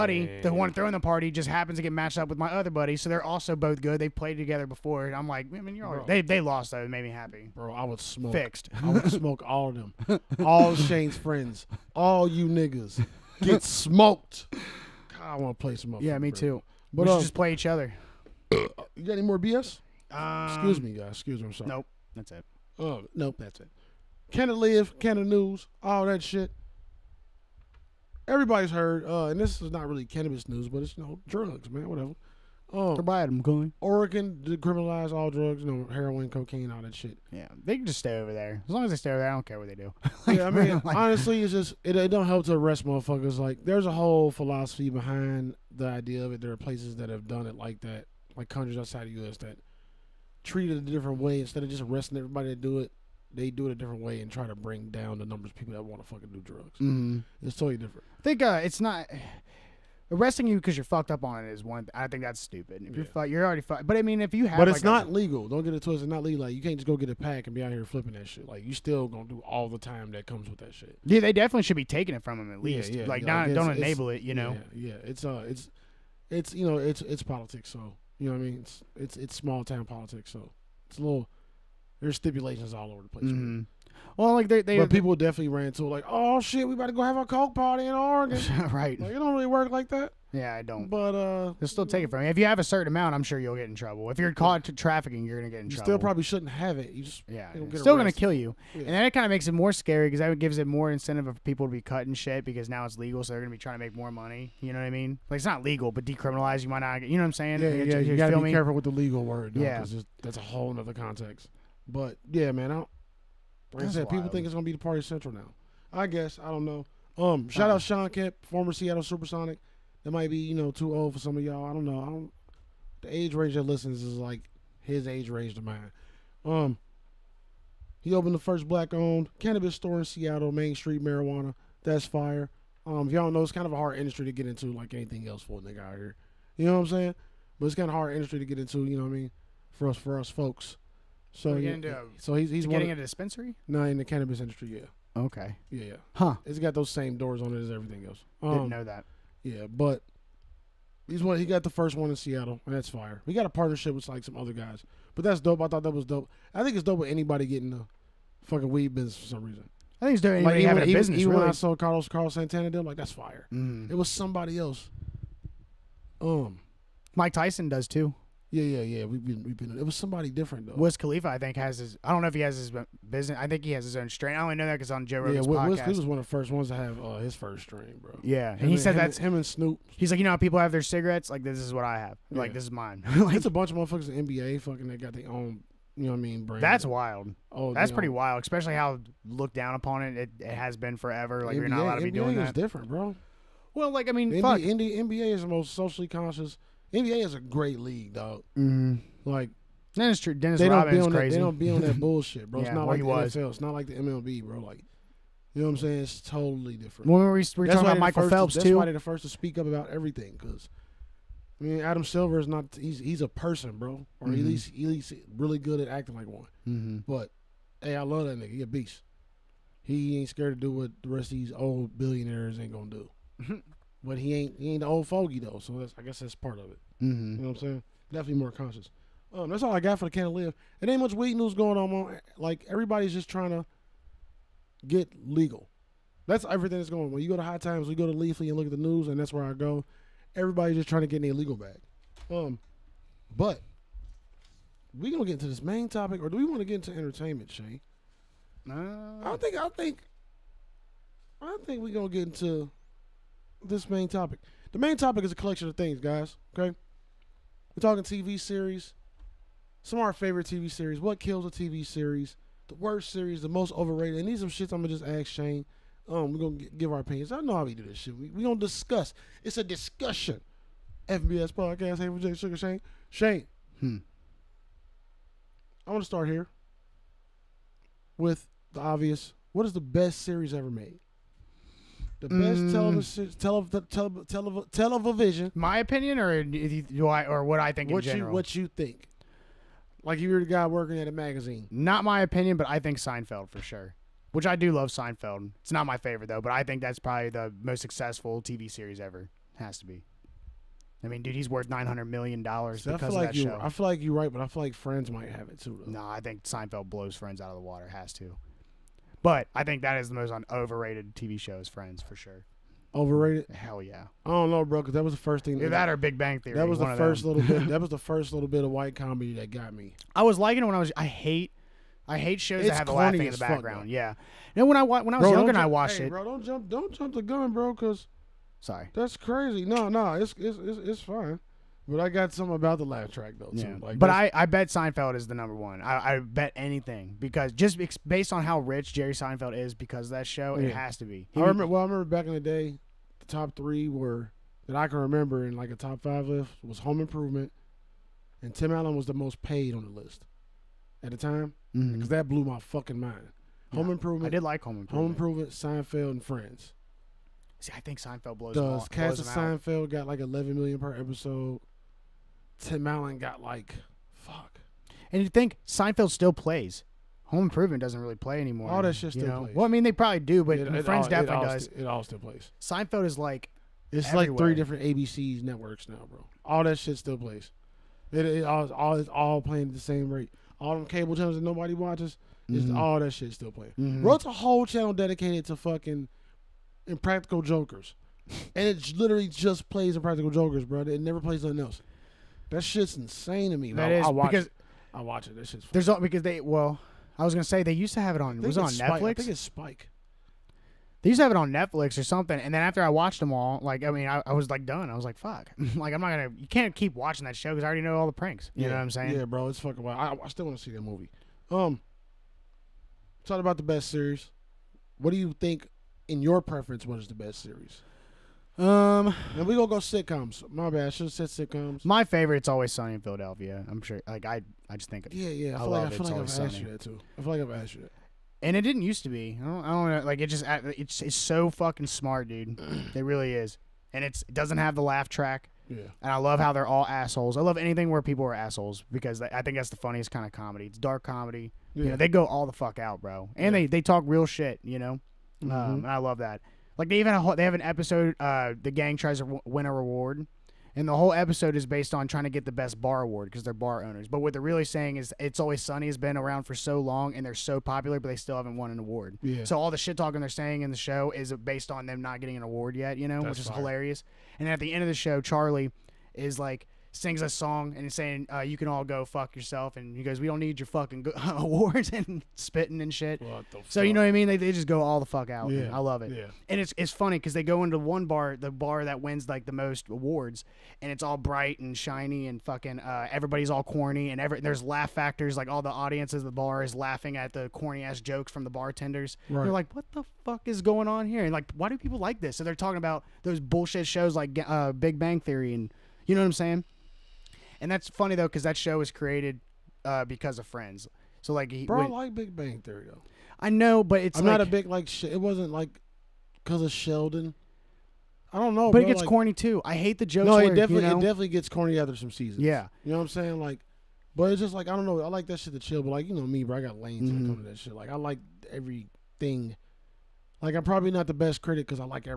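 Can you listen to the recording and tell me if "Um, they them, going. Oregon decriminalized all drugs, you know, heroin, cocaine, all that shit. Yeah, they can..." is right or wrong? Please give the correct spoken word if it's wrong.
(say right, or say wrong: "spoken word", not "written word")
right.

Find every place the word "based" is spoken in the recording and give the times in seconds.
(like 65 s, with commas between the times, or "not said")
338 s, 451 s, 461 s.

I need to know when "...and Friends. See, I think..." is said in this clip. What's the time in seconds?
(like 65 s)
356 s.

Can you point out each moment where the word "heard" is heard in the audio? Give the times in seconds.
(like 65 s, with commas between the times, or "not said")
28 s.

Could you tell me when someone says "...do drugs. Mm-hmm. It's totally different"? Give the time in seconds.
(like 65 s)
56 s.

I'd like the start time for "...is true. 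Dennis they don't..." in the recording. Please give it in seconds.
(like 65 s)
200 s.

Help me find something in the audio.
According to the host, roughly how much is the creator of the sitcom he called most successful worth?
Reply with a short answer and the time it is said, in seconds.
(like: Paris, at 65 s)
900 million dollars, at 301 s.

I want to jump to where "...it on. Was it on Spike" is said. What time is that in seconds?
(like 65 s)
398 s.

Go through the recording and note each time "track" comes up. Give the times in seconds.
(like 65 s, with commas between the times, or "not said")
333 s, 435 s.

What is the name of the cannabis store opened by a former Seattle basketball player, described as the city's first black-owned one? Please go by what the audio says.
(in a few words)
Main Street Marijuana.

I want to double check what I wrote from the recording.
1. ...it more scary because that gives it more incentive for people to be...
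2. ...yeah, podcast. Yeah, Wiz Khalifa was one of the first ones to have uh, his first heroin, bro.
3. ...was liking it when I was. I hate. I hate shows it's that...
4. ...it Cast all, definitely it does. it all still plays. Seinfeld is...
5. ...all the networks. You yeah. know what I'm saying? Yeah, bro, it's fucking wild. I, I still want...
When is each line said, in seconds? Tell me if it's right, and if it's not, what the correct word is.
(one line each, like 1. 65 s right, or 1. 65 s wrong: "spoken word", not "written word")
1. 99 s right
2. 175 s wrong: "strain", not "heroin"
3. 320 s right
4. 370 s wrong: "Friends", not "Cast"
5. 407 s wrong: "pranks", not "networks".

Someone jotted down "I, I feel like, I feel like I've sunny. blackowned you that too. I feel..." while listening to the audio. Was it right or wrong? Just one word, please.
wrong.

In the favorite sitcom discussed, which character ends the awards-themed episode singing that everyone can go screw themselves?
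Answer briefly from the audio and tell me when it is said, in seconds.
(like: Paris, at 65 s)
Charlie, at 465 s.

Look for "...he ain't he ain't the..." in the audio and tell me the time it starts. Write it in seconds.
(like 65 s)
224 s.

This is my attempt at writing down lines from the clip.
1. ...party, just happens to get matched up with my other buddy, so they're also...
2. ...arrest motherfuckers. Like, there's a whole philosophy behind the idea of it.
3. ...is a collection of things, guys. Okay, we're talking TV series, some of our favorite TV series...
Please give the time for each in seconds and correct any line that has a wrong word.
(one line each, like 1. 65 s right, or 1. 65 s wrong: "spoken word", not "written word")
1. 0 s right
2. 42 s right
3. 255 s right.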